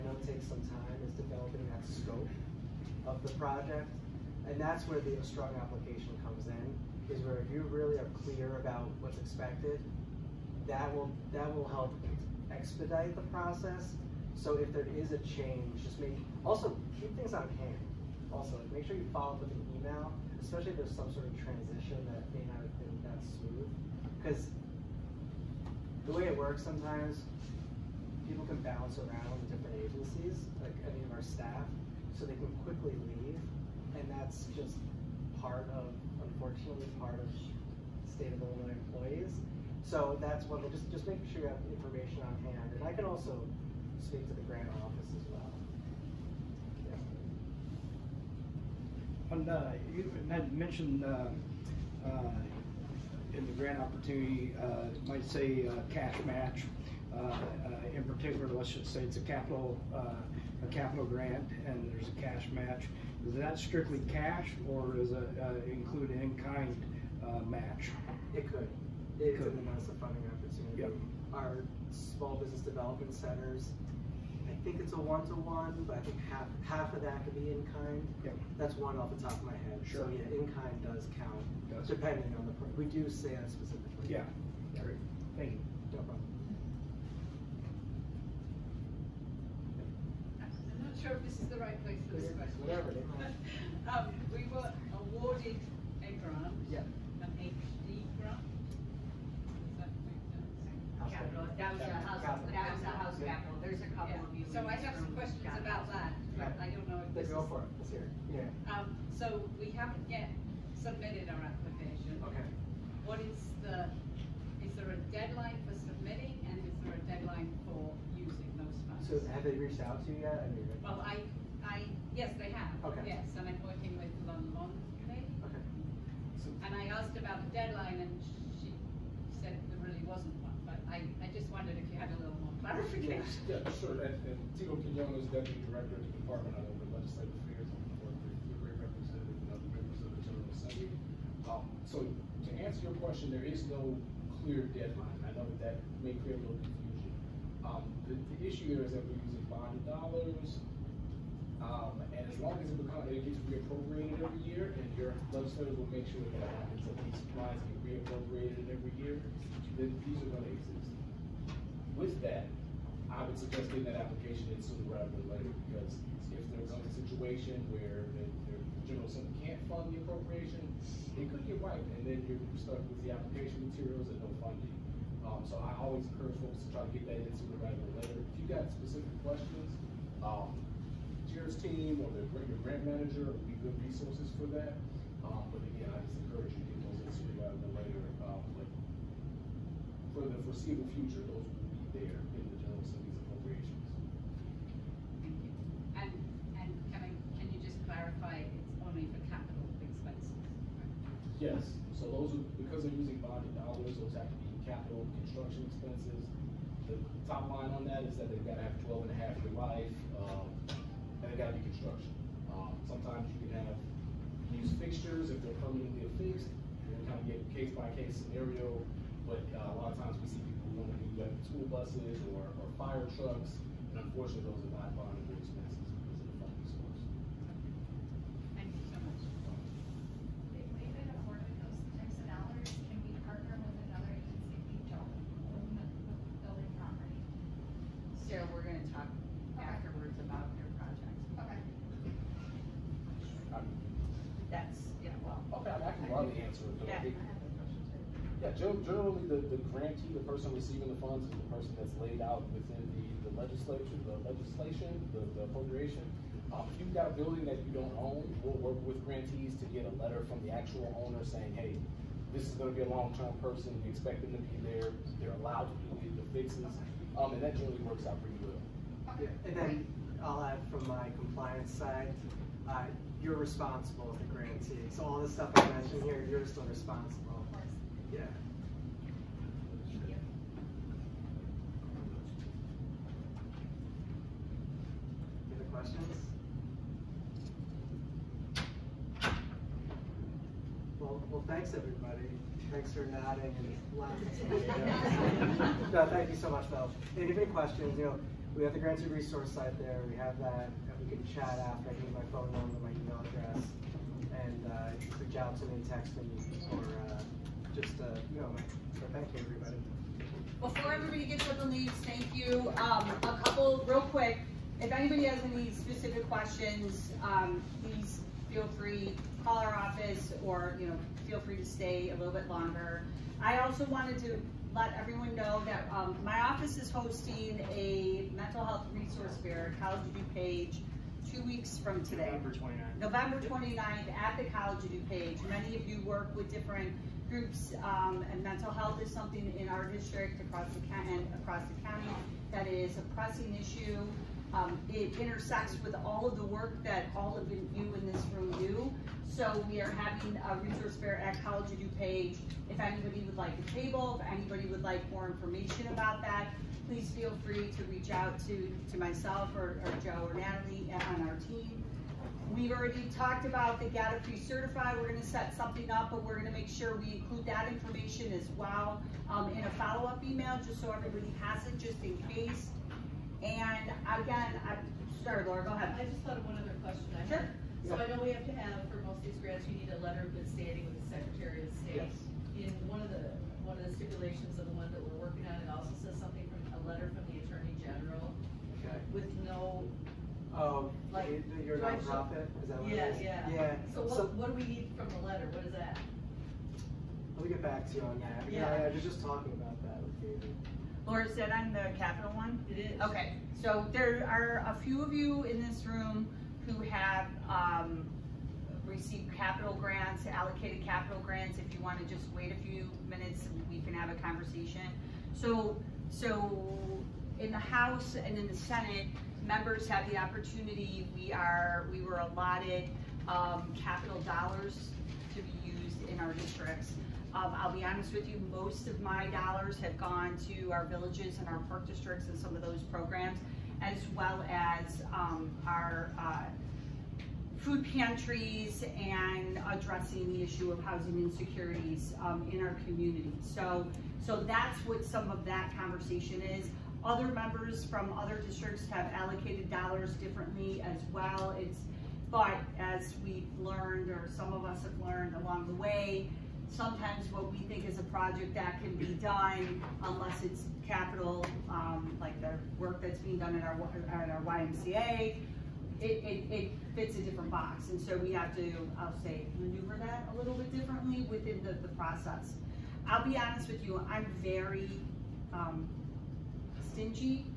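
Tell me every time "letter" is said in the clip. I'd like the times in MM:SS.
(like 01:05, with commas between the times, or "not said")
04:20, 06:20, 06:26, 06:35.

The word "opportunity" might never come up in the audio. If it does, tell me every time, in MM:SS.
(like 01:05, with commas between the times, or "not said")
00:53, 01:10, 07:00.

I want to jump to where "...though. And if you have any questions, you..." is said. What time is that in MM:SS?
04:56.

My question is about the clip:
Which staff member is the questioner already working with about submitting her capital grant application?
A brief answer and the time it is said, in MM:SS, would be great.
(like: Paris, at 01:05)
Lon Long, at 02:04.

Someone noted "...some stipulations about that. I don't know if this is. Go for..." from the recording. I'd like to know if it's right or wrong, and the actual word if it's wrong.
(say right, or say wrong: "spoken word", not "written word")
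wrong: "questions", not "stipulations".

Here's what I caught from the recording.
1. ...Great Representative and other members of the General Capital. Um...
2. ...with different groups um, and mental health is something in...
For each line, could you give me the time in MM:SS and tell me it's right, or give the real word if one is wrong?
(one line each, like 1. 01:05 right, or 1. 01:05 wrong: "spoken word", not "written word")
1. 02:18 wrong: "Assembly", not "Capital"
2. 05:36 right.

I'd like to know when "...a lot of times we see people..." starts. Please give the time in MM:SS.
03:39.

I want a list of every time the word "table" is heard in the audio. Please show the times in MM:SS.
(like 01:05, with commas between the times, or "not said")
05:53.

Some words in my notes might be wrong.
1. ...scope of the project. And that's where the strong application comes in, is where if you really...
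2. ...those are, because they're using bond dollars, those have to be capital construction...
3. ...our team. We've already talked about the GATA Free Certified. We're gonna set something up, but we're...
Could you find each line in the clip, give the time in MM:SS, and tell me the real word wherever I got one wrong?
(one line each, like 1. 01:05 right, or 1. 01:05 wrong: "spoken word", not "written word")
1. 00:01 right
2. 03:22 right
3. 06:01 right.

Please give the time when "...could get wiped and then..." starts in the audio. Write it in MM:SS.
02:51.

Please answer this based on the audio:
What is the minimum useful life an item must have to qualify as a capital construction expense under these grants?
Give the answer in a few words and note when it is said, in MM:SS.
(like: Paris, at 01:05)
12 and a half years, at 03:28.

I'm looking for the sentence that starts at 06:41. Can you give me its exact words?
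Laura said I'm the capital one?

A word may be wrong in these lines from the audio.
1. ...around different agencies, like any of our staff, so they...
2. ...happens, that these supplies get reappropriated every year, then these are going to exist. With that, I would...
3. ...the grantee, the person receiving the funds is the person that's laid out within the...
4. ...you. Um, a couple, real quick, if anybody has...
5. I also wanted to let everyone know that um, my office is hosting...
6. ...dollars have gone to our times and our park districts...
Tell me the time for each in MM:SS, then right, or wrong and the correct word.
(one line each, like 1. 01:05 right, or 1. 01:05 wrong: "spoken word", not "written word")
1. 00:29 right
2. 02:36 right
3. 04:09 right
4. 05:12 right
5. 05:23 right
6. 07:09 wrong: "villages", not "times".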